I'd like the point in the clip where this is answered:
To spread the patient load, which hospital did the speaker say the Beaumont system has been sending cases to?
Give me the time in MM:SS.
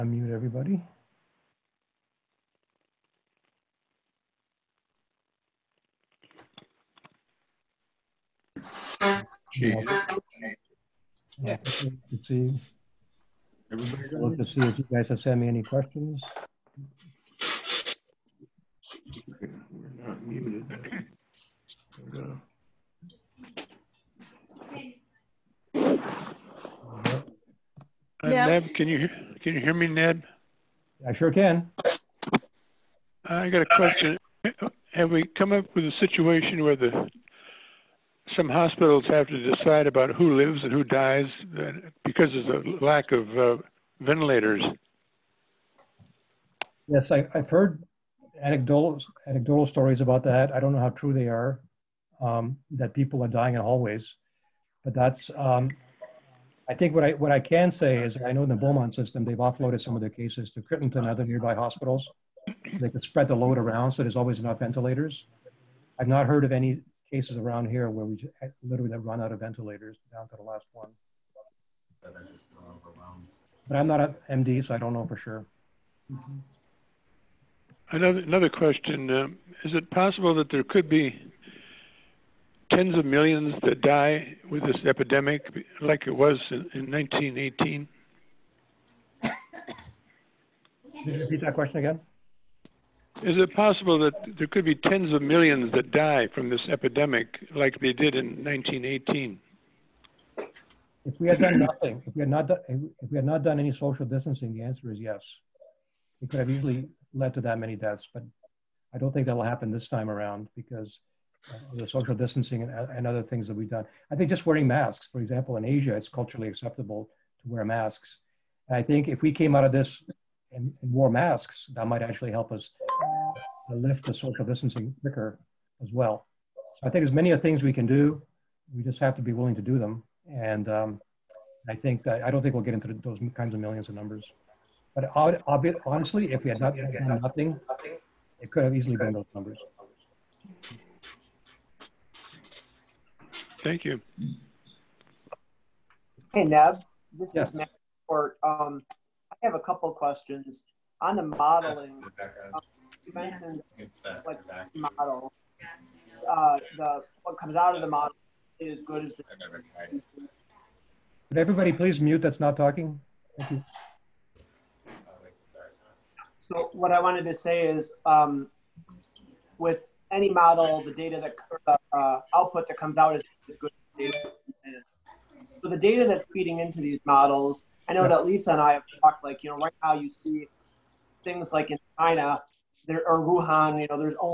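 01:00.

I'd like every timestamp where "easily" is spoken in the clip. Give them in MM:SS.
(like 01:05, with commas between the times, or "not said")
01:46, 02:18.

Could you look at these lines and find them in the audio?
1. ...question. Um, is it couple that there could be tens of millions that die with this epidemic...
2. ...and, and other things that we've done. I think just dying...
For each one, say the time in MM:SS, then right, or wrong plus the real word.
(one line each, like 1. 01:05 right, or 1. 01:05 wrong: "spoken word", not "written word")
1. 01:18 wrong: "possible", not "couple"
2. 01:52 wrong: "wearing", not "dying".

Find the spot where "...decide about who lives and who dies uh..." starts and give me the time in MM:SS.
00:39.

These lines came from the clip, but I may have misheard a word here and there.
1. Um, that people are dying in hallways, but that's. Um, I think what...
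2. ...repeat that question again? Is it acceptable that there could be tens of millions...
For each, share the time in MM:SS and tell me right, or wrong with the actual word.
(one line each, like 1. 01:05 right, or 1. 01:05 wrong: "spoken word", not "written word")
1. 00:52 right
2. 01:31 wrong: "possible", not "acceptable".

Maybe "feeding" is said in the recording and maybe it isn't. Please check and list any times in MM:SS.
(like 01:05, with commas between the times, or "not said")
02:56.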